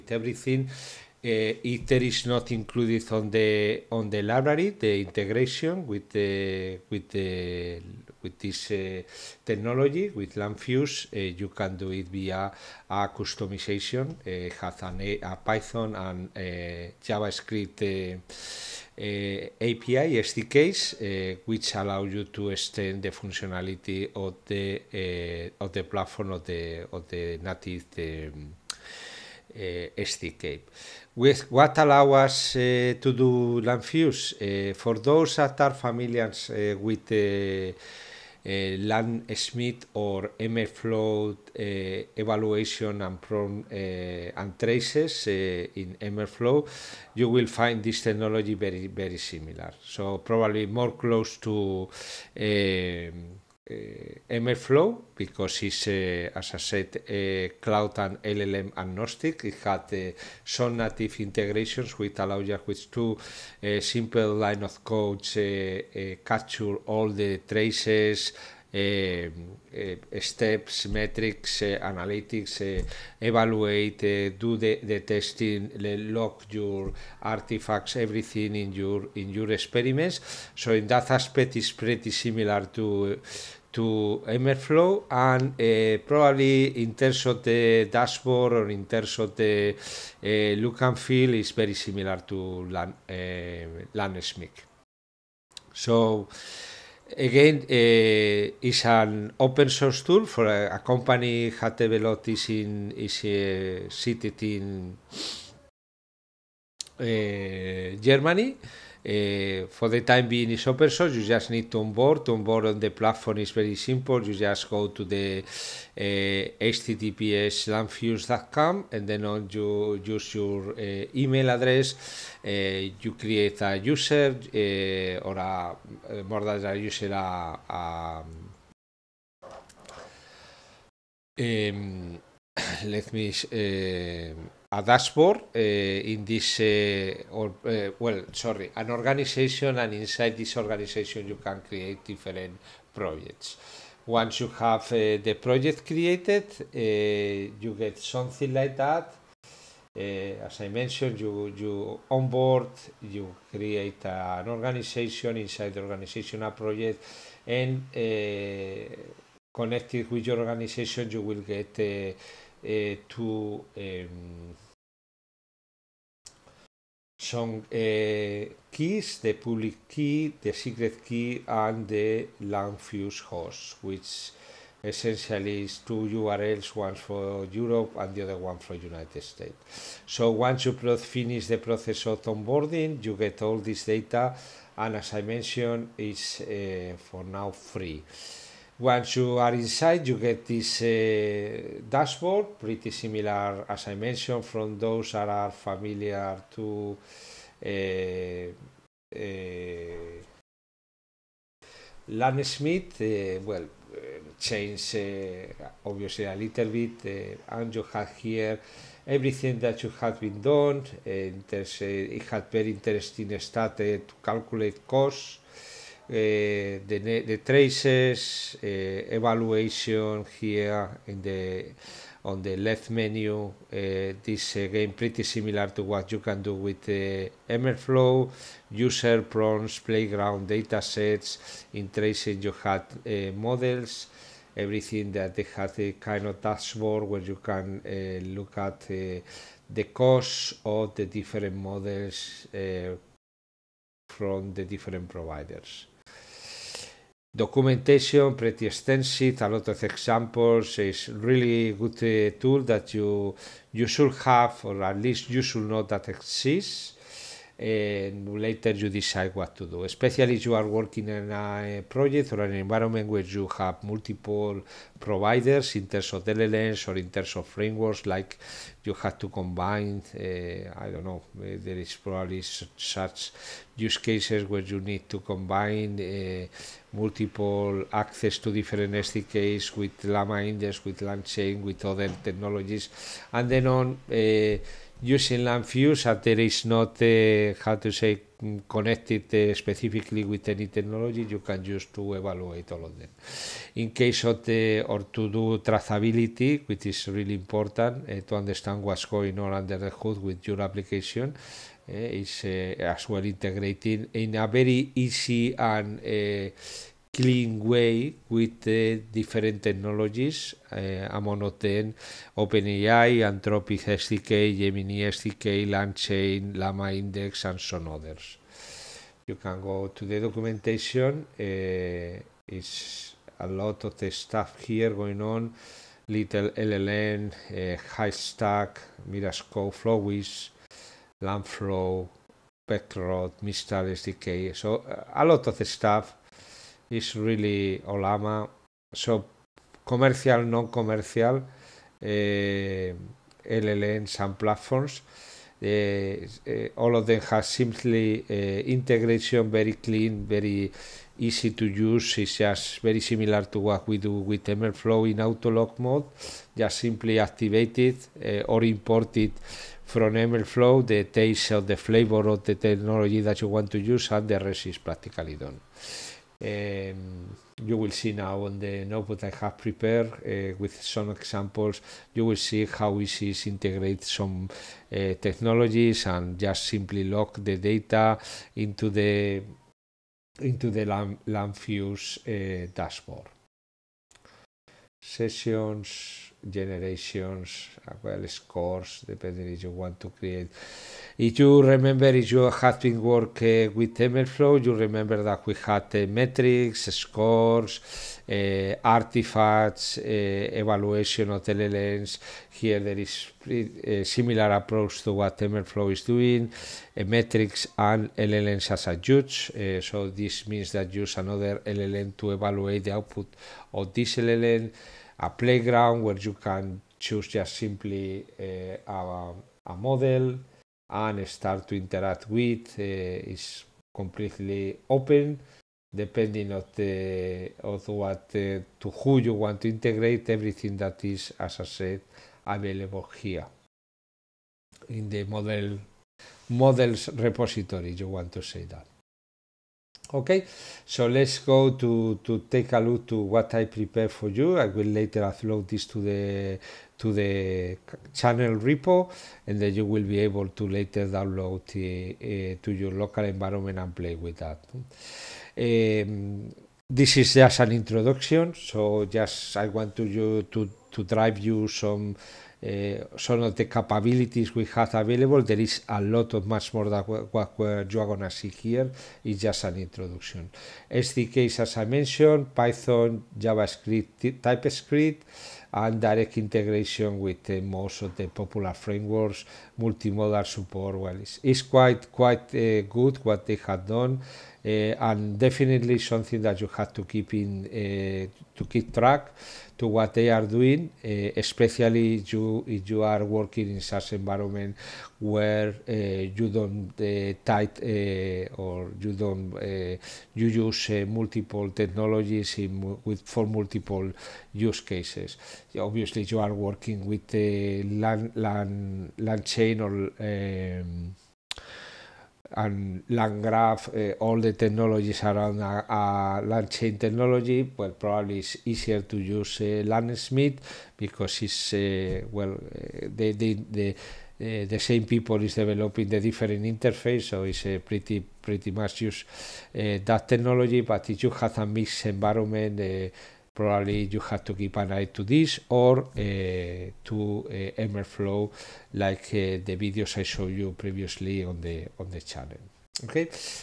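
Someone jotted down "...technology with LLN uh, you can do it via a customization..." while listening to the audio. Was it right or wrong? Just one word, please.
wrong.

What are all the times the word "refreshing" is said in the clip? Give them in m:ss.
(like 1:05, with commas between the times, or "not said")
not said.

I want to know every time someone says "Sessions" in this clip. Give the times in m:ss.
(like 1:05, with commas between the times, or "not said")
6:25.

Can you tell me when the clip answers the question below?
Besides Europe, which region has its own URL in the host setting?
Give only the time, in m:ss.
2:58.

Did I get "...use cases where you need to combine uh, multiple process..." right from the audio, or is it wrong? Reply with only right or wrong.
wrong.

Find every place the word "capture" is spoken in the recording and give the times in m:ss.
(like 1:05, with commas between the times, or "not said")
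1:06.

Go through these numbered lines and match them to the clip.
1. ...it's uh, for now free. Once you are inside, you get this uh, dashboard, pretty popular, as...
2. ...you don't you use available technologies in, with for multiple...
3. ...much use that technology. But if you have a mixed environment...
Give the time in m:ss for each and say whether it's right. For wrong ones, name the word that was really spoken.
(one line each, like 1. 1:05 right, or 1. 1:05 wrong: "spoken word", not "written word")
1. 3:05 wrong: "similar", not "popular"
2. 8:18 wrong: "multiple", not "available"
3. 8:48 right.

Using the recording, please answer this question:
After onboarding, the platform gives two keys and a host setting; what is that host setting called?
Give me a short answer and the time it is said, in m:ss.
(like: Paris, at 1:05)
fuse host, at 2:52.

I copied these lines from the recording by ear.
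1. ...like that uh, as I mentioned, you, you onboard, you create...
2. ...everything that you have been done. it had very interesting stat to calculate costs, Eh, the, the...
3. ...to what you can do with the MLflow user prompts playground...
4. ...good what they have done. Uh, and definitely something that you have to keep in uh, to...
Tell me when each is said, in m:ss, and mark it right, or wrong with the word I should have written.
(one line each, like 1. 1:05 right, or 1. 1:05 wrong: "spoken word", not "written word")
1. 2:28 right
2. 3:29 right
3. 3:45 right
4. 8:02 right.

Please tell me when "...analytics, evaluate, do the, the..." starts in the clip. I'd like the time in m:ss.
1:11.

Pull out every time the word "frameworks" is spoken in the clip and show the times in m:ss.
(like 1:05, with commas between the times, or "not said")
4:27, 7:58.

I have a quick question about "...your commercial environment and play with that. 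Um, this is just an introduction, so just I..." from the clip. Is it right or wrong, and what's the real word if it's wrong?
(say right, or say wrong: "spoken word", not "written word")
wrong: "local", not "commercial".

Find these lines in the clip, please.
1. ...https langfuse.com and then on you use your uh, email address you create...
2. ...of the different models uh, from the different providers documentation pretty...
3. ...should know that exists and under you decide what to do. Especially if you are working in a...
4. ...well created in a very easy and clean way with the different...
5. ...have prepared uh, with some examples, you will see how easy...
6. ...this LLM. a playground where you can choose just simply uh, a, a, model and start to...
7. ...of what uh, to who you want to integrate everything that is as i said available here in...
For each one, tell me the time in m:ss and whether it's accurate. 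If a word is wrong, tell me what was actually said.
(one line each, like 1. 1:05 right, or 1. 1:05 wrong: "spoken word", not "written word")
1. 1:56 right
2. 4:00 right
3. 4:15 wrong: "later", not "under"
4. 5:03 wrong: "integrated", not "created"
5. 6:09 right
6. 6:53 right
7. 7:07 right.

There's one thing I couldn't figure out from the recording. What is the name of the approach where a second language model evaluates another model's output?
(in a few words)
LLMs as a judge.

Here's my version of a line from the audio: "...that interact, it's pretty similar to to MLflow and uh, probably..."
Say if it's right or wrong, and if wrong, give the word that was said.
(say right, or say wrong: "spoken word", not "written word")
wrong: "aspect", not "interact".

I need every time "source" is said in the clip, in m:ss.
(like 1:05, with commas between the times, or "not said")
1:39, 1:50.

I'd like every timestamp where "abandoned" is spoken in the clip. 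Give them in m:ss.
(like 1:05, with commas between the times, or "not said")
not said.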